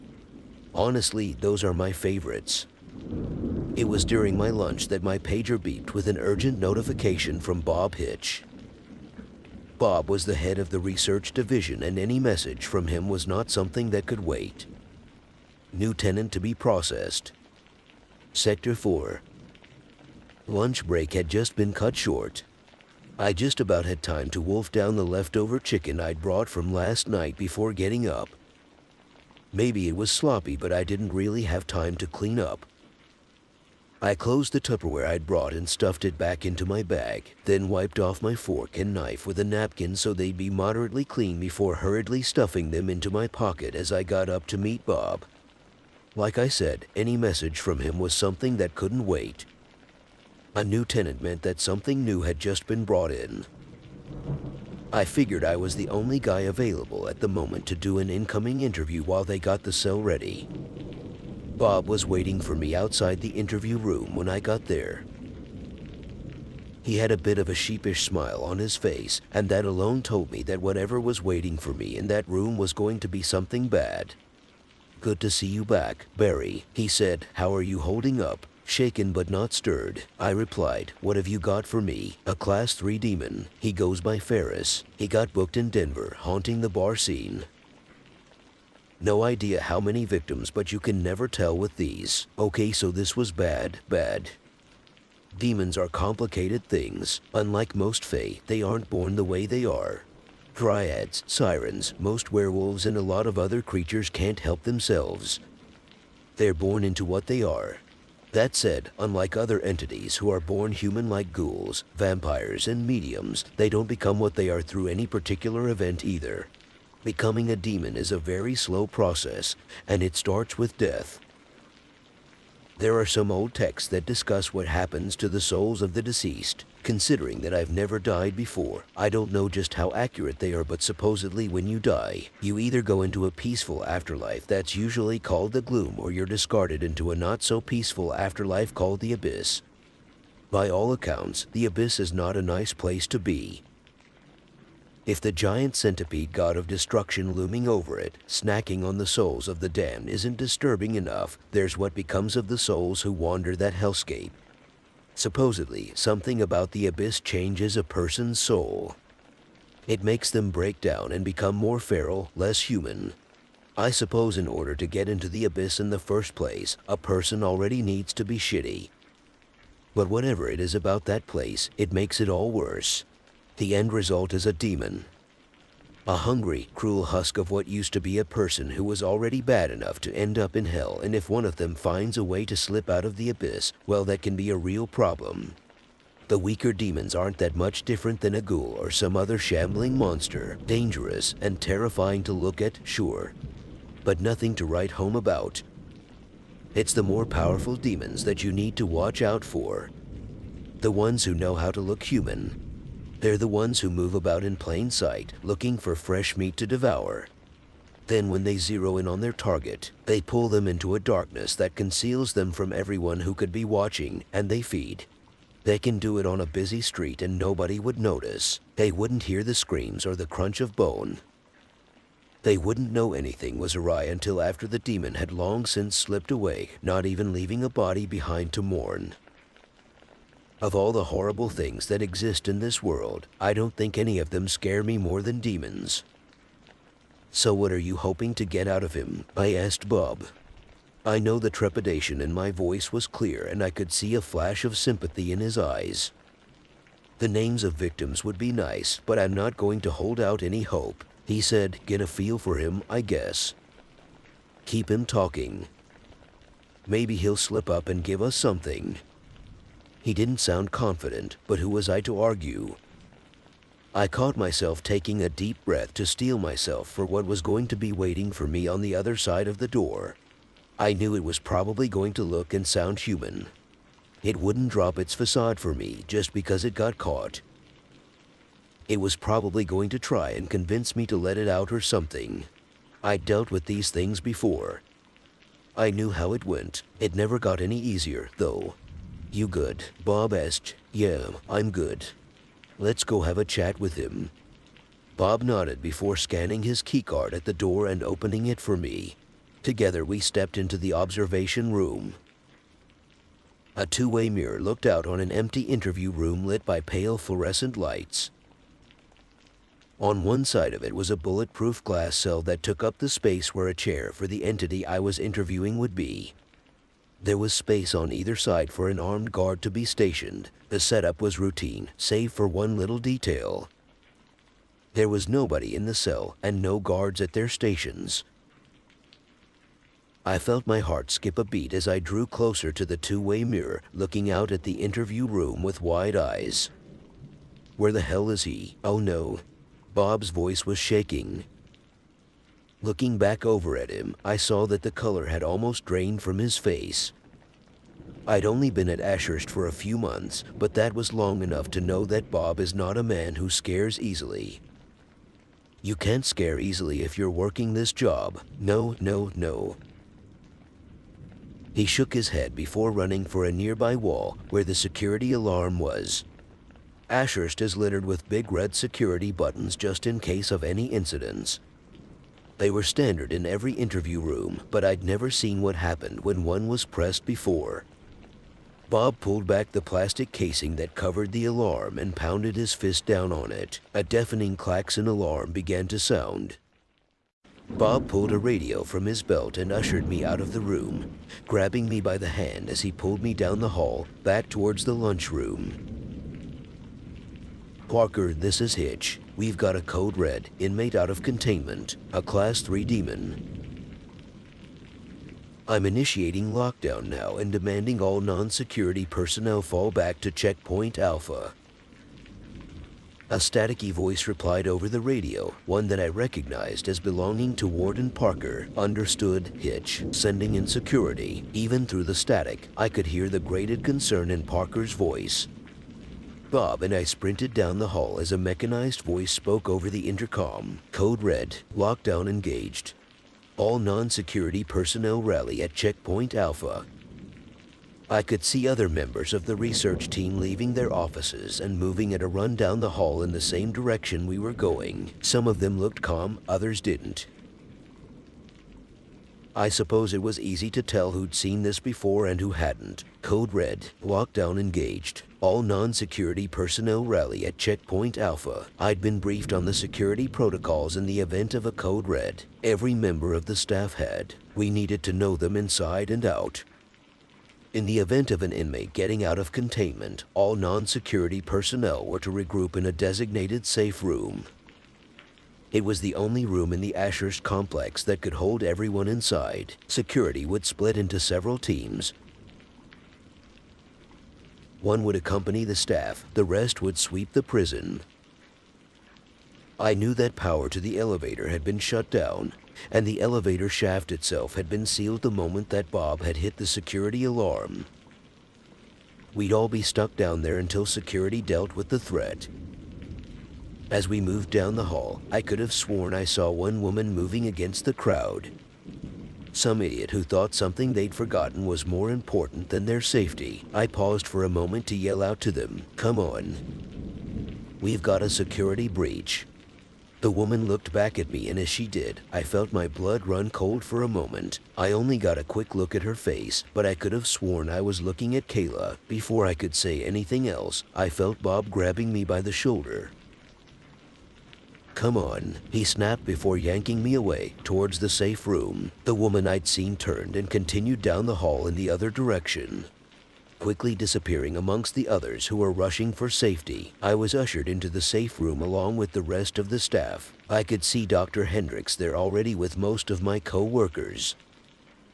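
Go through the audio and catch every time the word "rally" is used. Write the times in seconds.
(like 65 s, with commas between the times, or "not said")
435 s, 457 s.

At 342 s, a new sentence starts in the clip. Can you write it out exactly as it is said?
Looking back over at him, I saw that the color had almost drained from his face.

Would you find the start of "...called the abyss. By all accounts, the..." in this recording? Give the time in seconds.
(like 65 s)
138 s.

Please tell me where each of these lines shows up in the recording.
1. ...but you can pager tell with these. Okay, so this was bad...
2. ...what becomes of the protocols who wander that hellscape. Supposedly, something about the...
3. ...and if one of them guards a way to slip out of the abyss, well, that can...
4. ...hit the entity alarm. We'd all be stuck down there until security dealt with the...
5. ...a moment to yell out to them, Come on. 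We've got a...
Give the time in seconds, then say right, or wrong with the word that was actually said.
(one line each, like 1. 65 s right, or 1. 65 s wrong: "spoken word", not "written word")
1. 90 s wrong: "never", not "pager"
2. 151 s wrong: "souls", not "protocols"
3. 181 s wrong: "finds", not "guards"
4. 496 s wrong: "security", not "entity"
5. 514 s right.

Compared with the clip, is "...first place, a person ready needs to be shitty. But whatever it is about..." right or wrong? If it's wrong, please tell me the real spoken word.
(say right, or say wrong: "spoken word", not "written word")
wrong: "already", not "ready".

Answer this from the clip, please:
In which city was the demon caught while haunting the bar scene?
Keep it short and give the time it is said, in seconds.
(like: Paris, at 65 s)
Denver, at 85 s.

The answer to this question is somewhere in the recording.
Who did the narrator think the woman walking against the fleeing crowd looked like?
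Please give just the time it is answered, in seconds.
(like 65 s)
528 s.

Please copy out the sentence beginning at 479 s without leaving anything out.
Security would split into several teams.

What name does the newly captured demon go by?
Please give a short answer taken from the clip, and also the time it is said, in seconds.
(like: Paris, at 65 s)
Ferris, at 84 s.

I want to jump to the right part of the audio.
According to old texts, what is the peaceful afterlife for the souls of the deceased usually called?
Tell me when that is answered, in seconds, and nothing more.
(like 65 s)
135 s.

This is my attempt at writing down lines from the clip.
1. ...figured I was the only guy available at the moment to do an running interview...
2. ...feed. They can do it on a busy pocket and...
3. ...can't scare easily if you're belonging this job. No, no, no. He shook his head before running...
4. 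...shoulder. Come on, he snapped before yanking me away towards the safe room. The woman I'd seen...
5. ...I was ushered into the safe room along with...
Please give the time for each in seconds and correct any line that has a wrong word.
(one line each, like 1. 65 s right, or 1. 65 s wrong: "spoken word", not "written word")
1. 55 s wrong: "incoming", not "running"
2. 214 s wrong: "street", not "pocket"
3. 355 s wrong: "working", not "belonging"
4. 532 s right
5. 547 s right.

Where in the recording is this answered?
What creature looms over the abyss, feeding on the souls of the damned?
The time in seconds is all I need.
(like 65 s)
145 s.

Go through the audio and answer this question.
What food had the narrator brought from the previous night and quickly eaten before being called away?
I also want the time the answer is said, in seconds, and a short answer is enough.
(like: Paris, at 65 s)
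Chicken, at 25 s.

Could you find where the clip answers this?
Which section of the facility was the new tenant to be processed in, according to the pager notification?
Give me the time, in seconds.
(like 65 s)
18 s.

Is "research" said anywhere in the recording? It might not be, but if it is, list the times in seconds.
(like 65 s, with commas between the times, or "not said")
10 s, 439 s.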